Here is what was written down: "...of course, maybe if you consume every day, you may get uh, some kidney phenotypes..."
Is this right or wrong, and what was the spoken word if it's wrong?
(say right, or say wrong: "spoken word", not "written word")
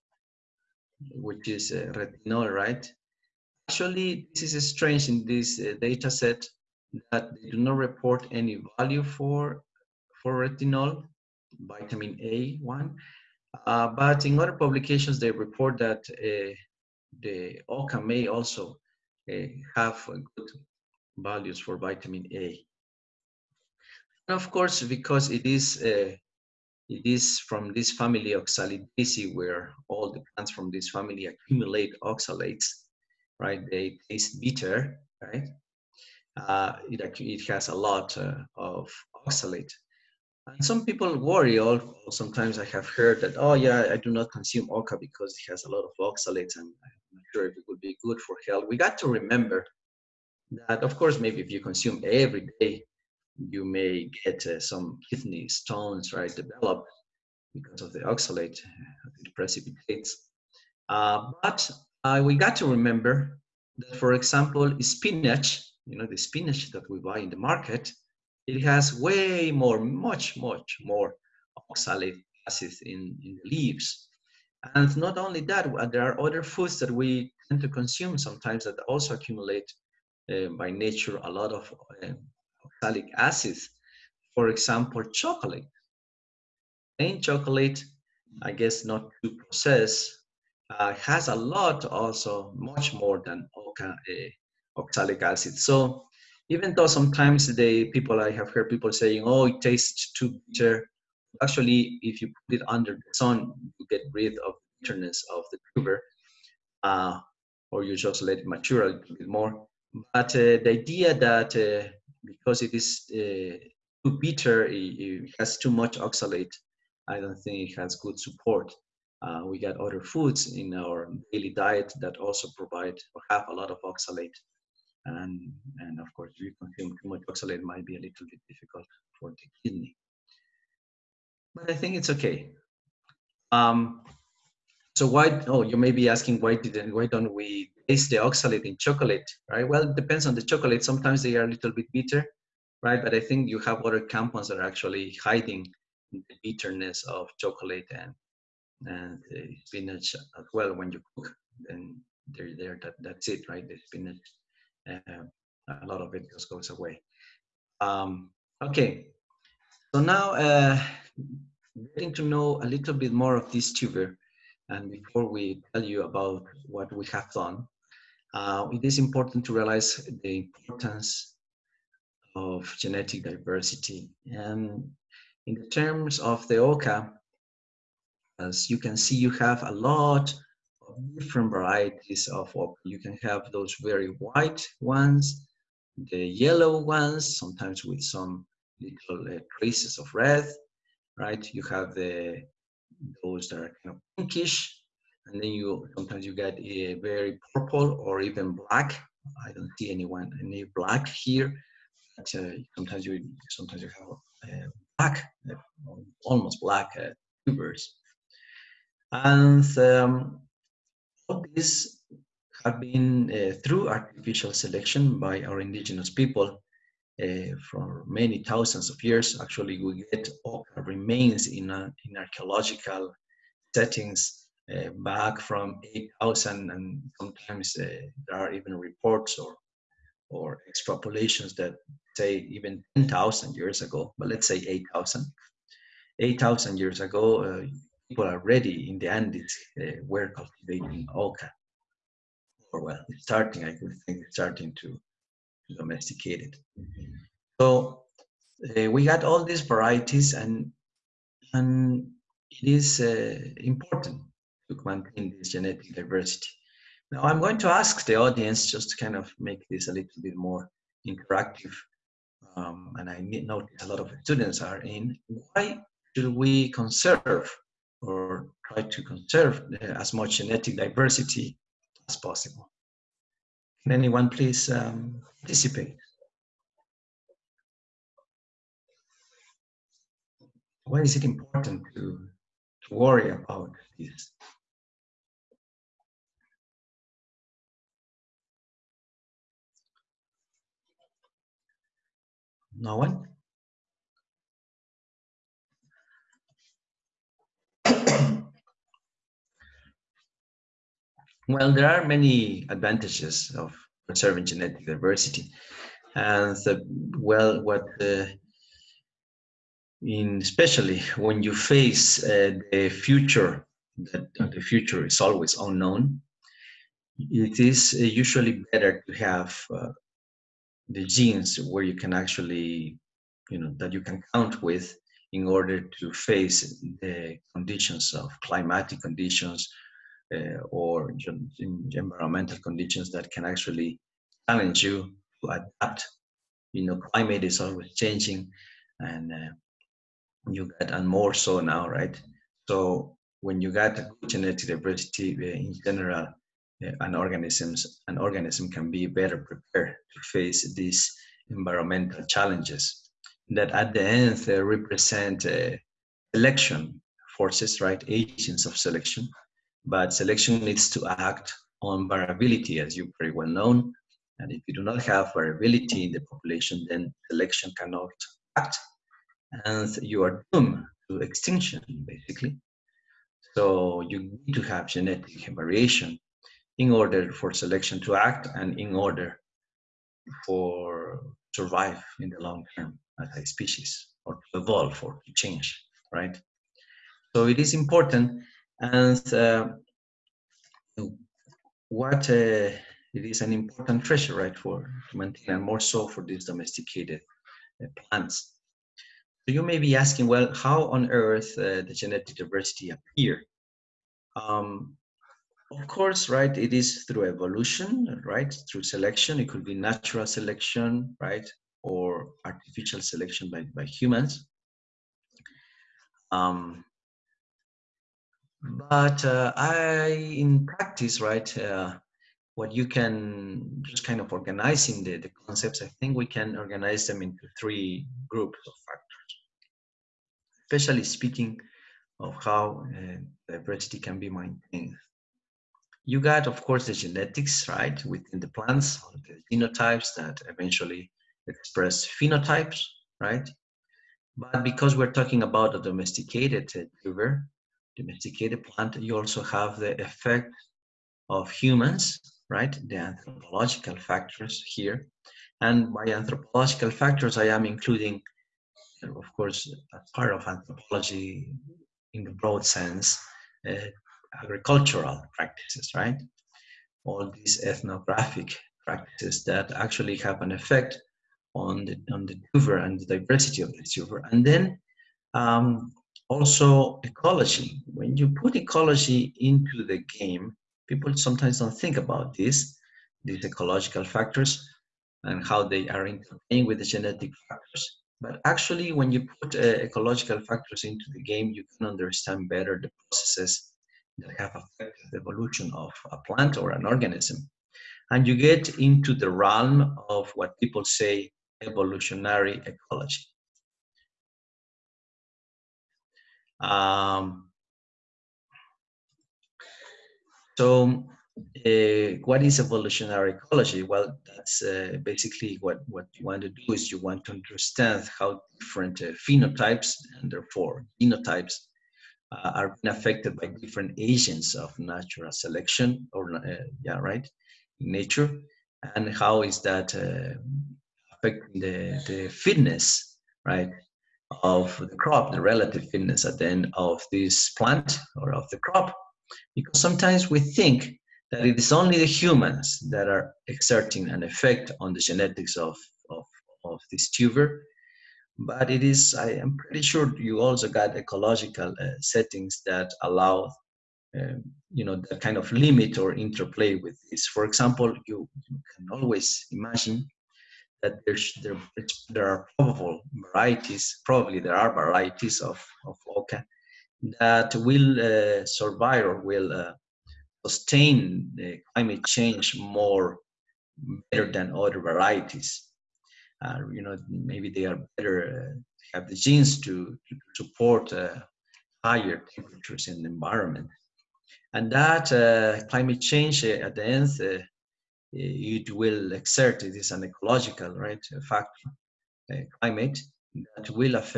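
wrong: "stones", not "phenotypes".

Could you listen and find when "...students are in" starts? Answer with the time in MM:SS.
04:24.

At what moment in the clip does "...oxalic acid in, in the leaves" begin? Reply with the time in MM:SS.
01:11.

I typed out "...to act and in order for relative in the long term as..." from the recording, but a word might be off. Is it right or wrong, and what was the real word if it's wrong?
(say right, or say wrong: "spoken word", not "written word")
wrong: "survive", not "relative".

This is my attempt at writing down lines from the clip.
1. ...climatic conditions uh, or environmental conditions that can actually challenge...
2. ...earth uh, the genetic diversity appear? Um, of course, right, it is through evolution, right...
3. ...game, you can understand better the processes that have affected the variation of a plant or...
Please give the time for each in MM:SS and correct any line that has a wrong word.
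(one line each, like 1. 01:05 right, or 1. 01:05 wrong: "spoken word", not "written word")
1. 05:28 right
2. 06:41 right
3. 08:11 wrong: "evolution", not "variation".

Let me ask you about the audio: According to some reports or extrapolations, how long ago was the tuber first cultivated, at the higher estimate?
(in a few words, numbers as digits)
10,000 years.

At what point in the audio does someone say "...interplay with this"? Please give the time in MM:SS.
09:16.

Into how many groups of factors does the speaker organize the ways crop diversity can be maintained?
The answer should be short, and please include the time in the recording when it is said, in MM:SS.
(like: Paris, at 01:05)
3, at 07:07.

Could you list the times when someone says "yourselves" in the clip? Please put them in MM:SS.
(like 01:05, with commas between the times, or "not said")
not said.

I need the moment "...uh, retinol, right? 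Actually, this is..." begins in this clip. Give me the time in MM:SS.
00:01.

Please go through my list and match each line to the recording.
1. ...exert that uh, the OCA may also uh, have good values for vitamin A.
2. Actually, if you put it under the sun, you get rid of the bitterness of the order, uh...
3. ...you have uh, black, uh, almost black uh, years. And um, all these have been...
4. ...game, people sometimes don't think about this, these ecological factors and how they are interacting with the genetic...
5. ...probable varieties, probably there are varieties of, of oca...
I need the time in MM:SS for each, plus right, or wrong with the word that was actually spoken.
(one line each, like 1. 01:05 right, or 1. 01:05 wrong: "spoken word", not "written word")
1. 00:15 wrong: "report", not "exert"
2. 01:41 wrong: "tuber", not "order"
3. 03:23 wrong: "tubers", not "years"
4. 08:00 right
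5. 09:22 right.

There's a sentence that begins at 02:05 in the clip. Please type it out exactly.
And, and of course, if you consume too much oxalate, might be a little bit difficult for the kidney.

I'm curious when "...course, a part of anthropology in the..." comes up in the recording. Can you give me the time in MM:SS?
07:39.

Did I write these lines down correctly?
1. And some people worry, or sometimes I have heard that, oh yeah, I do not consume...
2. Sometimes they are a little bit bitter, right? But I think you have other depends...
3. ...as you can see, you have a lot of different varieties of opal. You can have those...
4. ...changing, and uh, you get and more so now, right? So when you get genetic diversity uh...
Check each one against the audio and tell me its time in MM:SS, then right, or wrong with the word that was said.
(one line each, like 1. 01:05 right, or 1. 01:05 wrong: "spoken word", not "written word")
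1. 00:40 right
2. 02:20 wrong: "compounds", not "depends"
3. 02:58 right
4. 05:37 right.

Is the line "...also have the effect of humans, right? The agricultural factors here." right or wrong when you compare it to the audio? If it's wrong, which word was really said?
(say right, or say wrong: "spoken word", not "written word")
wrong: "anthropological", not "agricultural".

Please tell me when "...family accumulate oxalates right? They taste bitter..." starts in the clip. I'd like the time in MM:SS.
00:30.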